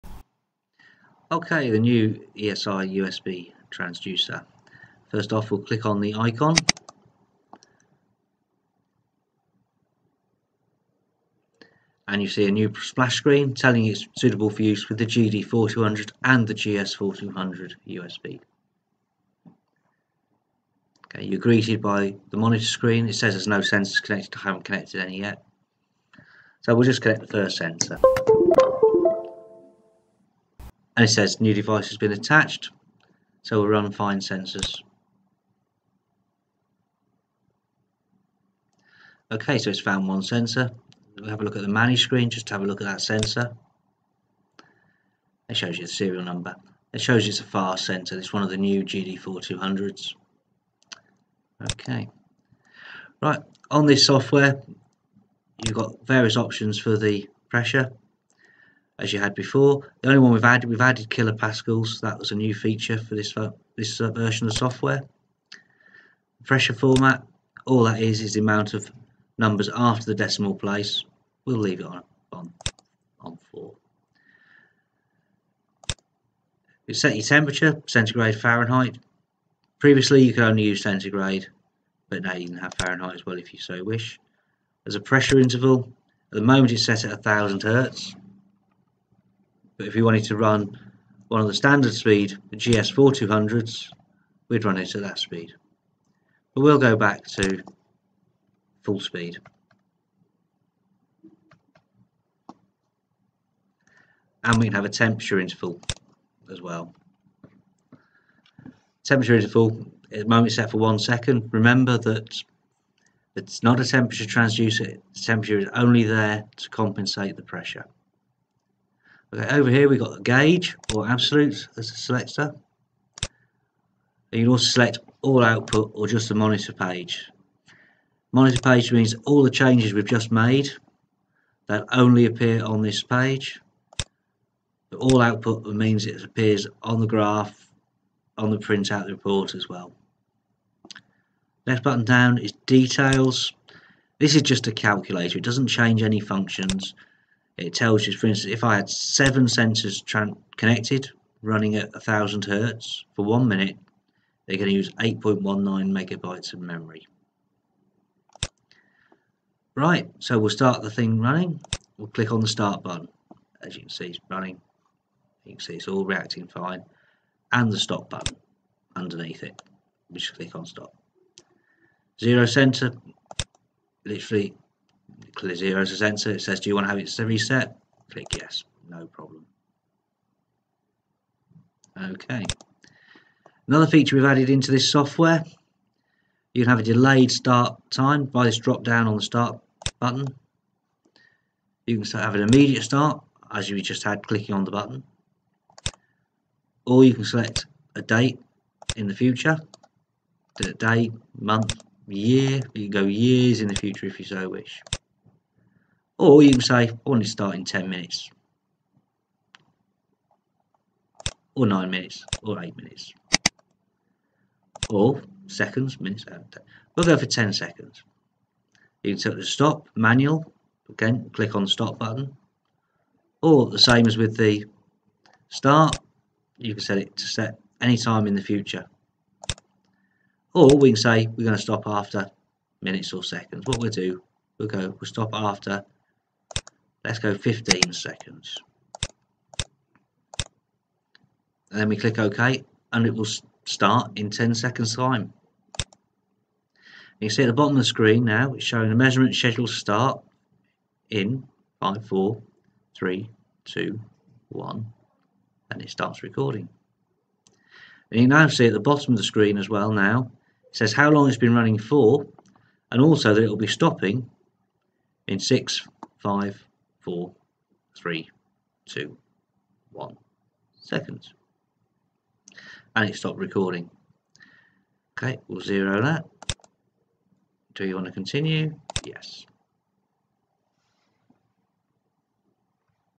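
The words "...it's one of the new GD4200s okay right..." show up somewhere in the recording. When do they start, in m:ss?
0:48.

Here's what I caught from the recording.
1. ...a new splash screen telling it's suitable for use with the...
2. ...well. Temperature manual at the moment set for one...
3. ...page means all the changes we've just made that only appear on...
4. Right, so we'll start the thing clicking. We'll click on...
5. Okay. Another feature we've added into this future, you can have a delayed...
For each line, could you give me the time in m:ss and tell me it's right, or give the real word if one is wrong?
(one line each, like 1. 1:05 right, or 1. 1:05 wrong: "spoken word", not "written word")
1. 0:12 right
2. 1:46 wrong: "interval", not "manual"
3. 2:08 right
4. 2:39 wrong: "running", not "clicking"
5. 3:02 wrong: "software", not "future".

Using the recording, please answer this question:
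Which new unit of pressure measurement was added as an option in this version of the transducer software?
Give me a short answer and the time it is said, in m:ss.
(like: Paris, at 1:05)
kilopascals, at 1:01.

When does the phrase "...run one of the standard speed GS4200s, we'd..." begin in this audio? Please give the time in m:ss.
1:30.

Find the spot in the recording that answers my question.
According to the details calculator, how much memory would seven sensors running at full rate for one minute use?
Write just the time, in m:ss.
2:34.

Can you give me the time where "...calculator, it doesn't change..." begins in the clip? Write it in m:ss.
2:24.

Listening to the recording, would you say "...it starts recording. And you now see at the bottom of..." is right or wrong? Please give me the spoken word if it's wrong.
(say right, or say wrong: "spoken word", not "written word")
right.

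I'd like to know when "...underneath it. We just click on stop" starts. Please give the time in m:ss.
2:48.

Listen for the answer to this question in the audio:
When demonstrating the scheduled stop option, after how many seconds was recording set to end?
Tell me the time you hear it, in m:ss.
3:57.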